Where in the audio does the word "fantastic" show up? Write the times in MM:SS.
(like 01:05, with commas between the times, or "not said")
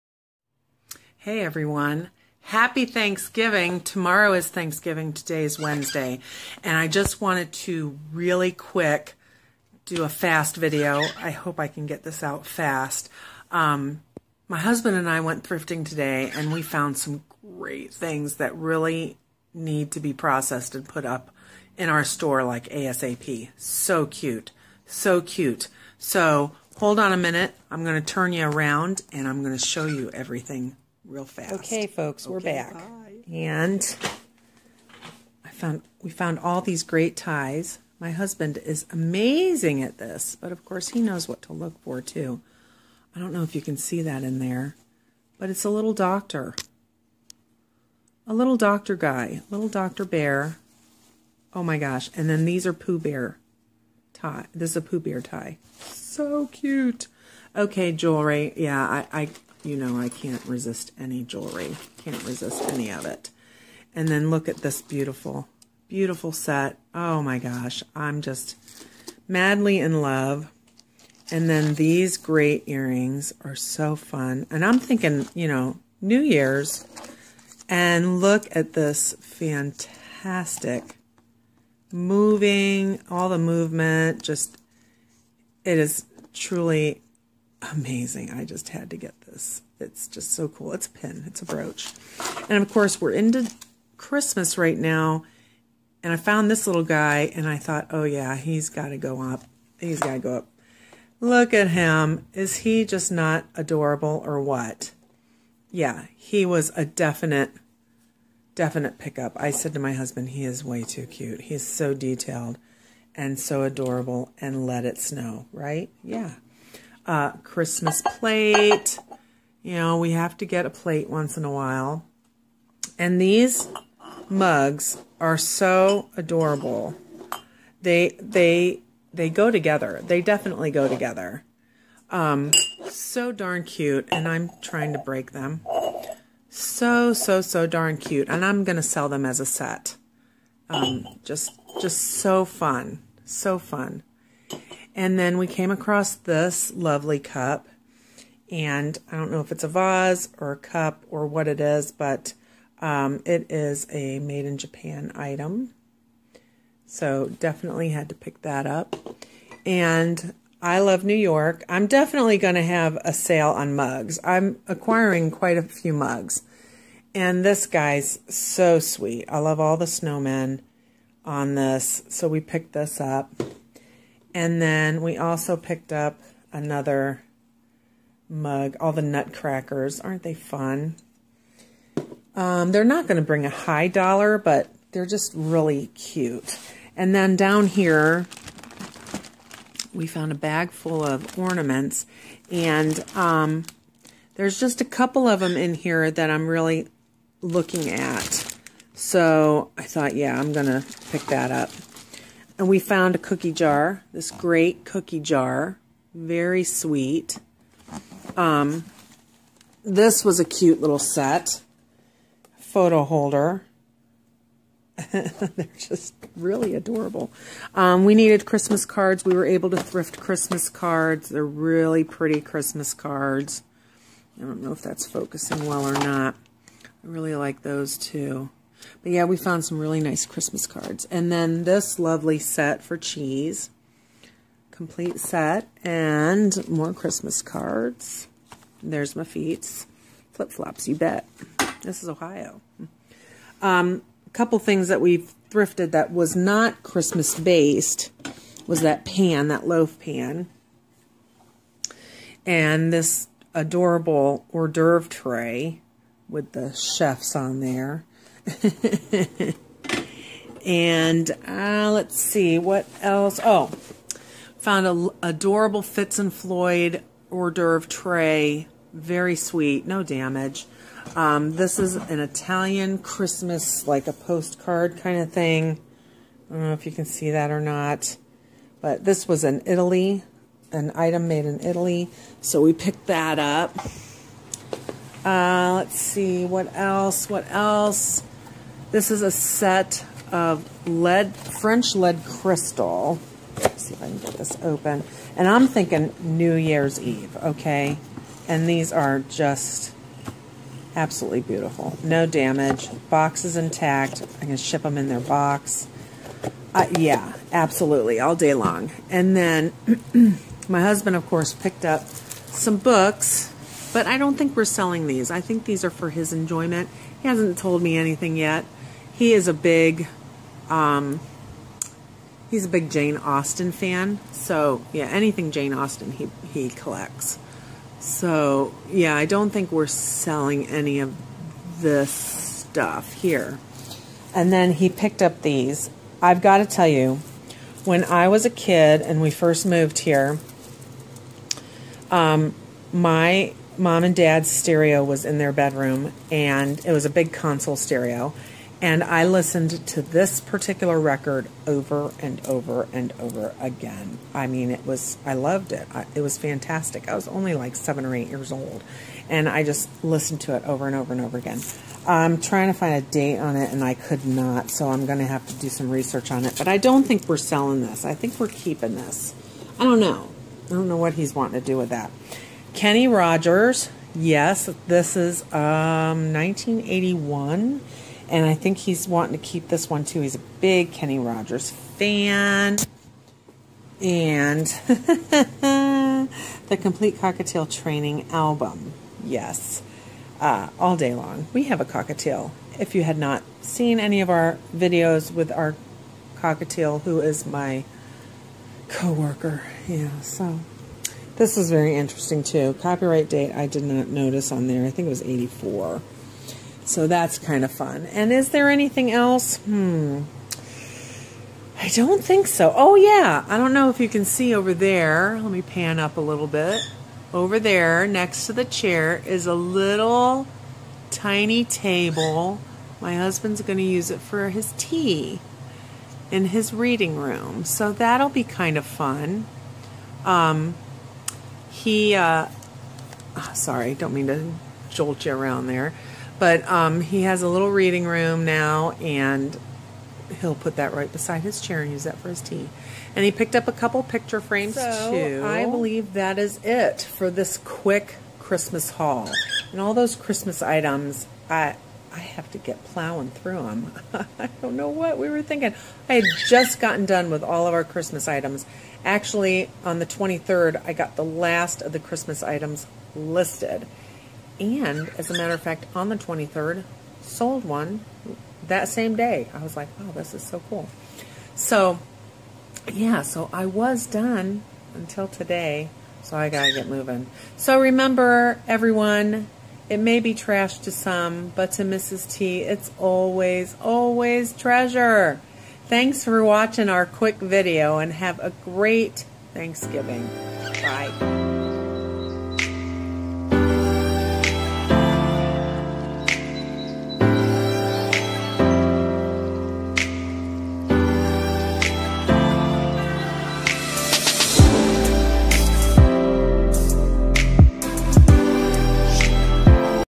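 01:19, 05:56.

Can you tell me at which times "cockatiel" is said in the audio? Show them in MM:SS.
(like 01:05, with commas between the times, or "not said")
06:27, 06:31, 06:36.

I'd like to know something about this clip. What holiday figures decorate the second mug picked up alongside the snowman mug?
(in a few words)
Nutcrackers.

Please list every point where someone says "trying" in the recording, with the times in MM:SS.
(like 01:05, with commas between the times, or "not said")
02:14, 06:02.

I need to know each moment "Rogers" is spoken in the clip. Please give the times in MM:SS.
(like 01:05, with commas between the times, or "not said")
06:13, 06:21.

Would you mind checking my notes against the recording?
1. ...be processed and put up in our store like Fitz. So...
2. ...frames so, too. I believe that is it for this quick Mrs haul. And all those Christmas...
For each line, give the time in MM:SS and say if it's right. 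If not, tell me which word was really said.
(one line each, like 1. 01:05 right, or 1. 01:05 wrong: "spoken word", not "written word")
1. 00:19 wrong: "ASAP", not "Fitz"
2. 07:24 wrong: "Christmas", not "Mrs".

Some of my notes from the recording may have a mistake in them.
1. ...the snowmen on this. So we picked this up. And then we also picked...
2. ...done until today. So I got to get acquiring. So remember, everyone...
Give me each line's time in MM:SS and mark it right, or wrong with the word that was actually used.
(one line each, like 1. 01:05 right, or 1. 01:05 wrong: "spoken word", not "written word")
1. 02:49 right
2. 07:54 wrong: "moving", not "acquiring".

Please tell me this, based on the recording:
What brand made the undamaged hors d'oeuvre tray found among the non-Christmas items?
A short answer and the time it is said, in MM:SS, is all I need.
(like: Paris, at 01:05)
Fitz and Floyd, at 04:25.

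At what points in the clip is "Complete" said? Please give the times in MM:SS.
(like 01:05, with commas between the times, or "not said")
03:54, 06:26.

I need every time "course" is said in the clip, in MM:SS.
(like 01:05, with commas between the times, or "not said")
00:40, 01:32, 05:11.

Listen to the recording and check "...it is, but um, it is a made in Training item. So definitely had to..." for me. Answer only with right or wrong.
wrong.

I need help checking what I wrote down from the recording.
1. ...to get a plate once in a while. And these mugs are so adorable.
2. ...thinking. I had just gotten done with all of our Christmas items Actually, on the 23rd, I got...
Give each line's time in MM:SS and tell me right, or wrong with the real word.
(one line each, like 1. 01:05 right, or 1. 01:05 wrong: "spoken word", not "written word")
1. 02:00 right
2. 07:35 right.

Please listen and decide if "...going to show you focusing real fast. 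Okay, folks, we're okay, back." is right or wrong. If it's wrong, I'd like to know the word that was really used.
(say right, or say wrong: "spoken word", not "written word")
wrong: "everything", not "focusing".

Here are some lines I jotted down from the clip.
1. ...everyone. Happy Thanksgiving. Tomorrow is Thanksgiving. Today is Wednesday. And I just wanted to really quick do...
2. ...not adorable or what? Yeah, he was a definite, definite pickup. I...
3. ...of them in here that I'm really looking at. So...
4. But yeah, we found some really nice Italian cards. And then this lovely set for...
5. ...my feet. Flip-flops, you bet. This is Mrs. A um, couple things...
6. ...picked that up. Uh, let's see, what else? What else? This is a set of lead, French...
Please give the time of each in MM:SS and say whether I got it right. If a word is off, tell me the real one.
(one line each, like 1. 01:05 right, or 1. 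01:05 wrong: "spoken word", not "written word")
1. 00:01 right
2. 01:43 right
3. 03:15 right
4. 03:49 wrong: "Christmas", not "Italian"
5. 03:59 wrong: "Ohio", not "Mrs"
6. 04:42 right.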